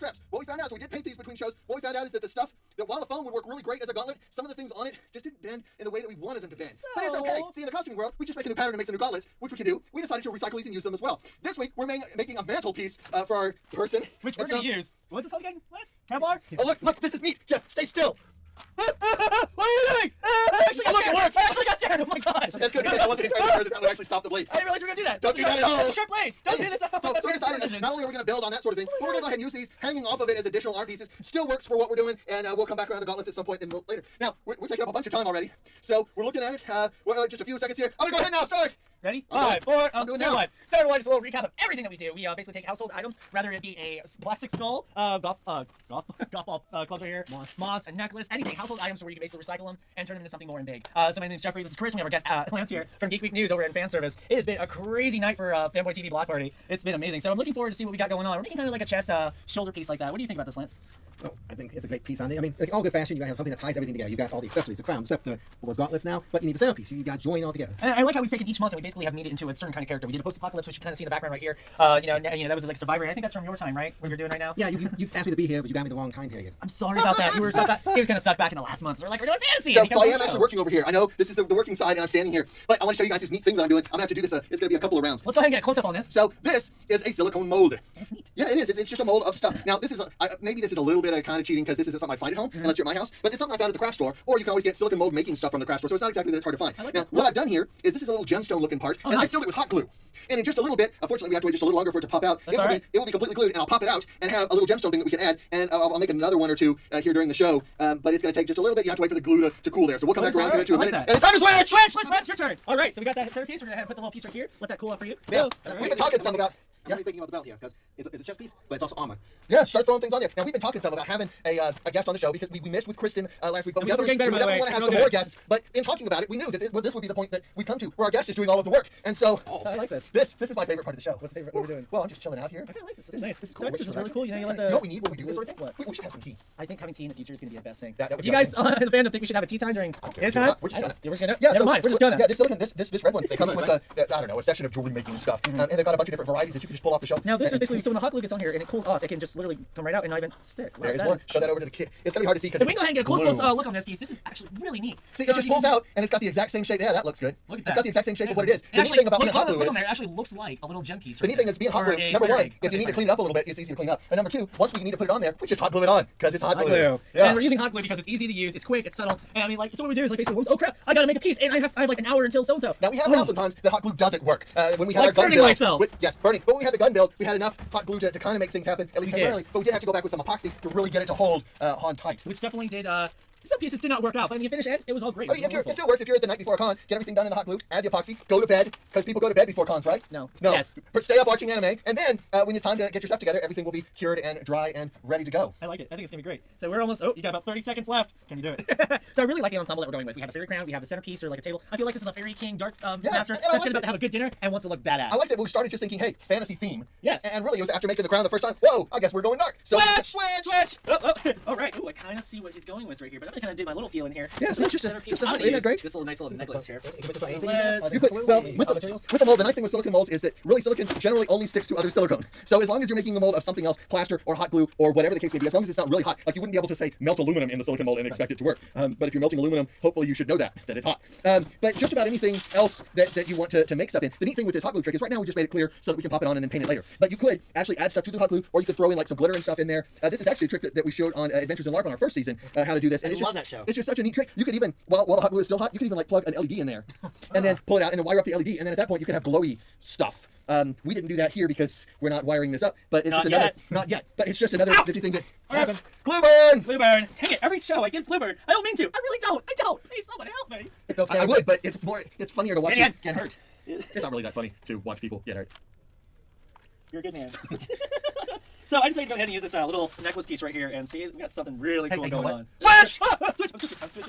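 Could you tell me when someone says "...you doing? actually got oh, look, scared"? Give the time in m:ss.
0:19.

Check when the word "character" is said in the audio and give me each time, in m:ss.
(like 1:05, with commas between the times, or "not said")
1:09.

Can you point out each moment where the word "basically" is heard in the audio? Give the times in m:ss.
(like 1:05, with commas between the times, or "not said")
0:42, 0:49, 1:08, 2:27, 2:50.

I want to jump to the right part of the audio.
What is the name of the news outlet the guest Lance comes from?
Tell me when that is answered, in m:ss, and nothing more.
0:53.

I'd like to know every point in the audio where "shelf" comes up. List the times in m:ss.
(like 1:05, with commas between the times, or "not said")
2:27.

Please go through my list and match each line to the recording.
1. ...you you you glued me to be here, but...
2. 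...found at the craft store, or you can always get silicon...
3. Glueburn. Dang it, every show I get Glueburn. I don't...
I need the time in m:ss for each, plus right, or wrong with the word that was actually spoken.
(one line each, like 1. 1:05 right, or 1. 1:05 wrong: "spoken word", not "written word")
1. 1:14 wrong: "asked", not "glued"
2. 1:33 right
3. 4:16 right.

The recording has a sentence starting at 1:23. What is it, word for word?
I'm gonna have to do this.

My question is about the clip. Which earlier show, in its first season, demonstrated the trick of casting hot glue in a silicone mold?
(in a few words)
Adventures in LARP.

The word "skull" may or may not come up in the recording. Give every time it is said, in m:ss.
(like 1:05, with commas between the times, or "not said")
0:44.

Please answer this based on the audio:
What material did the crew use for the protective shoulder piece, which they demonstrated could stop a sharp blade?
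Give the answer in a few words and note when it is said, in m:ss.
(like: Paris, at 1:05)
Kevlar, at 0:16.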